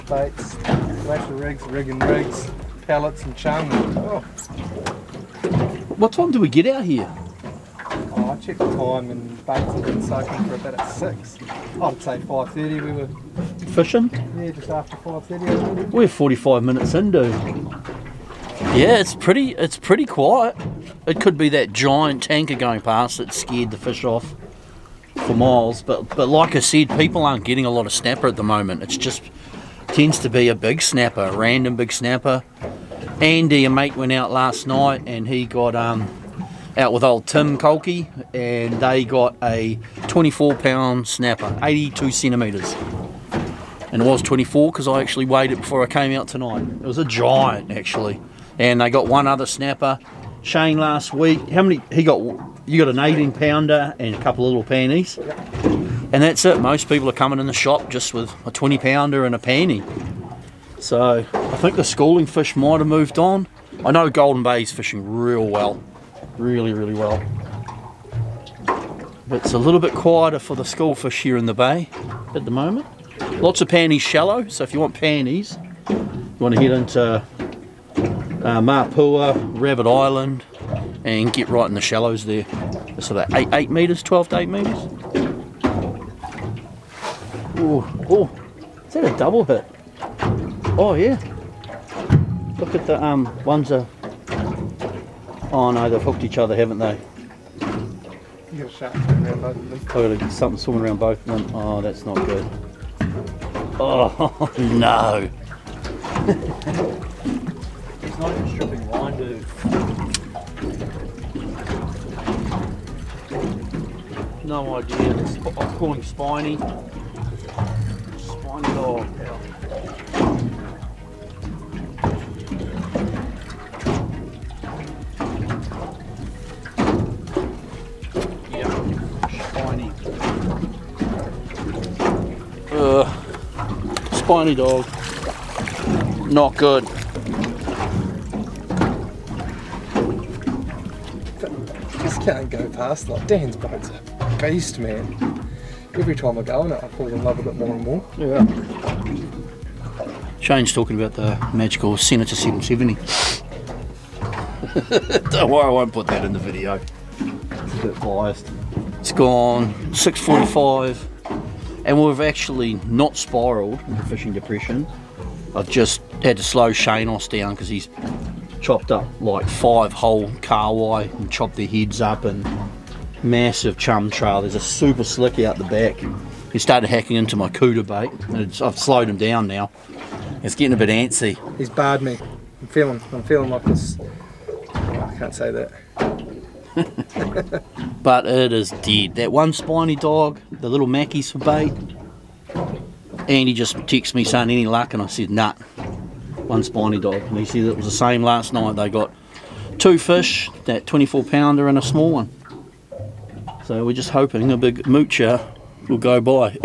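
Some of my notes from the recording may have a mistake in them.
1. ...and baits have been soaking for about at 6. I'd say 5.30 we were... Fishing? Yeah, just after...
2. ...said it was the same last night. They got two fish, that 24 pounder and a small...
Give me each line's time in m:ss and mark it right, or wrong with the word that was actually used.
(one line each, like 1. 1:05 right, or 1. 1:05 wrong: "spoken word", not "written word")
1. 0:09 right
2. 3:17 right.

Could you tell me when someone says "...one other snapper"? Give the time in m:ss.
0:49.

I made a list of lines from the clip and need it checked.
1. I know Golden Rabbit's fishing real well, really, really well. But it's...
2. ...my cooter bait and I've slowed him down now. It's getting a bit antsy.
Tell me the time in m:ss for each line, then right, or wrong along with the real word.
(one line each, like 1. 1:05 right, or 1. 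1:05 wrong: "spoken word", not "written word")
1. 1:03 wrong: "Bay", not "Rabbit"
2. 2:57 right.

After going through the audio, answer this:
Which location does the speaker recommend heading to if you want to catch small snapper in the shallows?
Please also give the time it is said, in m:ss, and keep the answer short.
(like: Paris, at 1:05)
Rabbit Island, at 1:19.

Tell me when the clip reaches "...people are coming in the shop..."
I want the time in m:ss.
0:56.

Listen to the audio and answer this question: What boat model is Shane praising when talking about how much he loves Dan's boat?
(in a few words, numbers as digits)
Senator 770.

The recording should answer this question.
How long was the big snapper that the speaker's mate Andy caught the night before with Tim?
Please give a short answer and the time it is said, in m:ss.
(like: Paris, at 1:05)
82 centimetres, at 0:41.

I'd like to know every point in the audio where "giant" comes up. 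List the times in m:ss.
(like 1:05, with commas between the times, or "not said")
0:21, 0:47.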